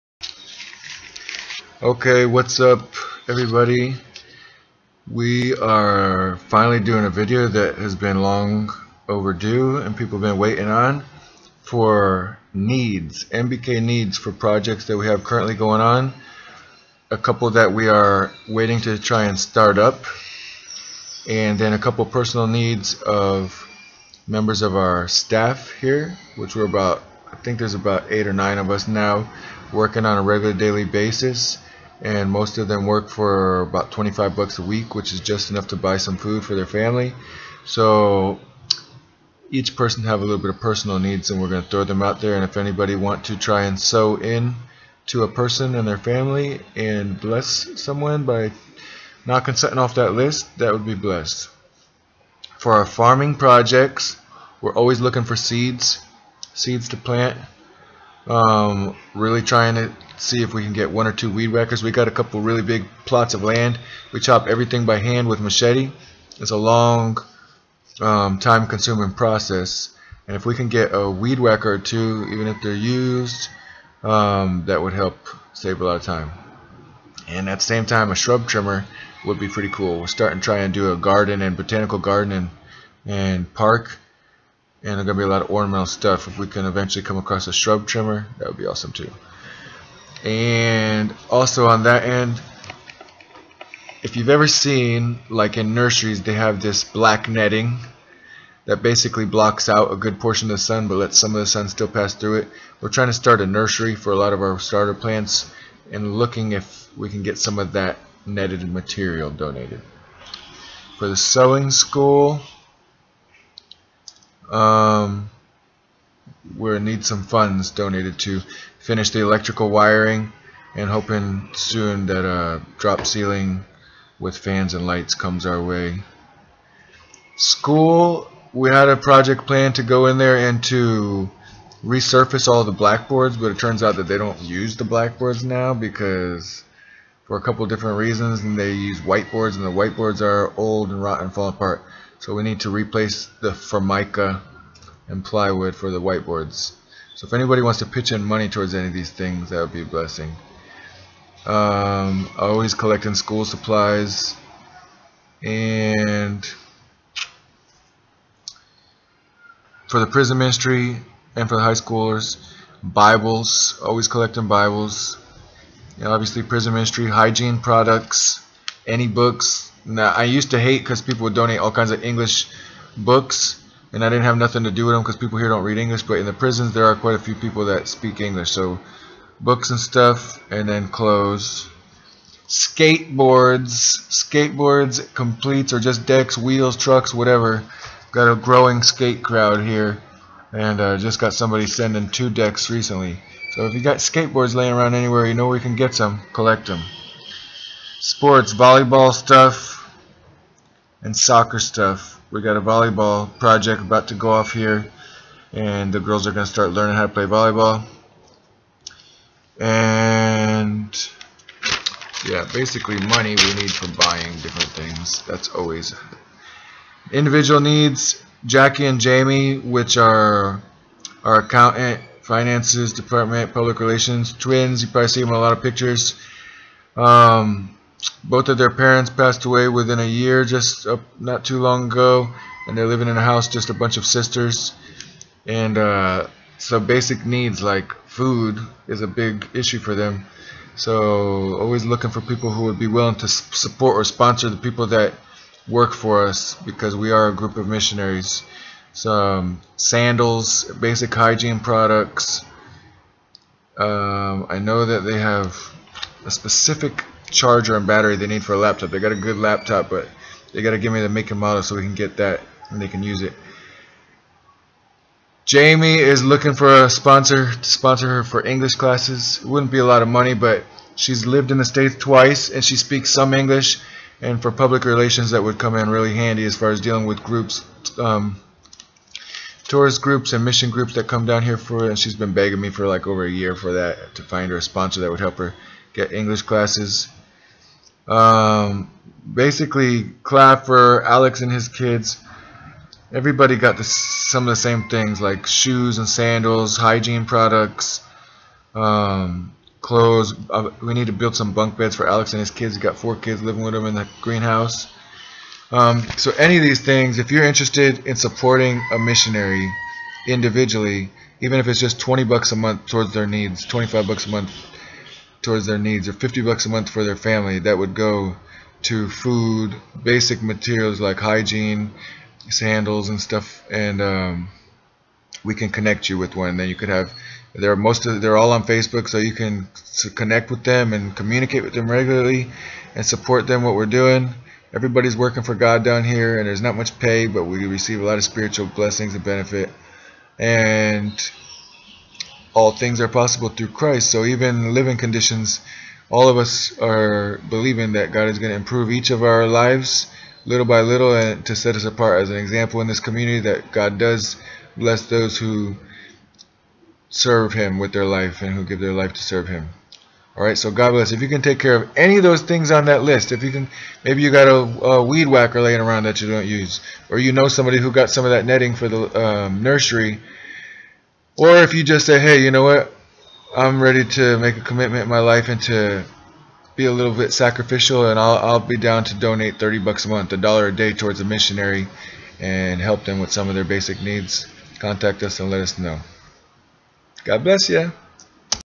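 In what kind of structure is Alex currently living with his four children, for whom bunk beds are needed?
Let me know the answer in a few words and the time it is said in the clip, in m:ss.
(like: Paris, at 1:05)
Greenhouse, at 5:04.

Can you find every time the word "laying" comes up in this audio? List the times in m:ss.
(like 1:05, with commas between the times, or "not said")
3:14, 6:05.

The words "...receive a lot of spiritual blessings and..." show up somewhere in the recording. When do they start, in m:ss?
5:37.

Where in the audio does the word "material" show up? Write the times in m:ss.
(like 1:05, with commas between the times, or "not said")
1:48, 5:20.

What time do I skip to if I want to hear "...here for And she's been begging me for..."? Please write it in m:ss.
4:41.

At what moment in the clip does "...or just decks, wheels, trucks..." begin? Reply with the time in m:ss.
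3:05.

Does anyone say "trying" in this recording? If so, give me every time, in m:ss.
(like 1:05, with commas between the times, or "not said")
0:59, 1:42.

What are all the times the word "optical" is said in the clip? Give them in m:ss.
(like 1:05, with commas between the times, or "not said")
not said.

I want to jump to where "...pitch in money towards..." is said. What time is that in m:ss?
2:27.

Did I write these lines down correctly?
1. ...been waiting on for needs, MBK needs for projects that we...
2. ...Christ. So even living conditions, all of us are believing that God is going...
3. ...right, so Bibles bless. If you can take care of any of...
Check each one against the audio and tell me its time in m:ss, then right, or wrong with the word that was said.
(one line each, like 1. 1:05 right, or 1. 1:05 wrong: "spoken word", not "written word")
1. 0:10 right
2. 5:43 right
3. 6:00 wrong: "God", not "Bibles".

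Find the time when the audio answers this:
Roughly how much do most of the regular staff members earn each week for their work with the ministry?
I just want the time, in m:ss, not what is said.
0:33.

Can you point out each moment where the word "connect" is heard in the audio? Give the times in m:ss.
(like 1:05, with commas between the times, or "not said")
5:25, 5:30.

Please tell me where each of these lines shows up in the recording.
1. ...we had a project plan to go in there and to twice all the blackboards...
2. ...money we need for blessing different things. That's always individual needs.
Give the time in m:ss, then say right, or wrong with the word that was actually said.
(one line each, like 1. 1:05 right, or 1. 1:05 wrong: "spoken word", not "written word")
1. 2:08 wrong: "resurface", not "twice"
2. 3:33 wrong: "buying", not "blessing".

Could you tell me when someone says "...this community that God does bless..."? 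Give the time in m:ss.
5:52.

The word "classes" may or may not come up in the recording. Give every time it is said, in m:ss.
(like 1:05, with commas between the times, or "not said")
4:28, 4:46.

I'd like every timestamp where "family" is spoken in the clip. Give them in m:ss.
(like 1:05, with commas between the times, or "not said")
0:36, 0:45, 5:17.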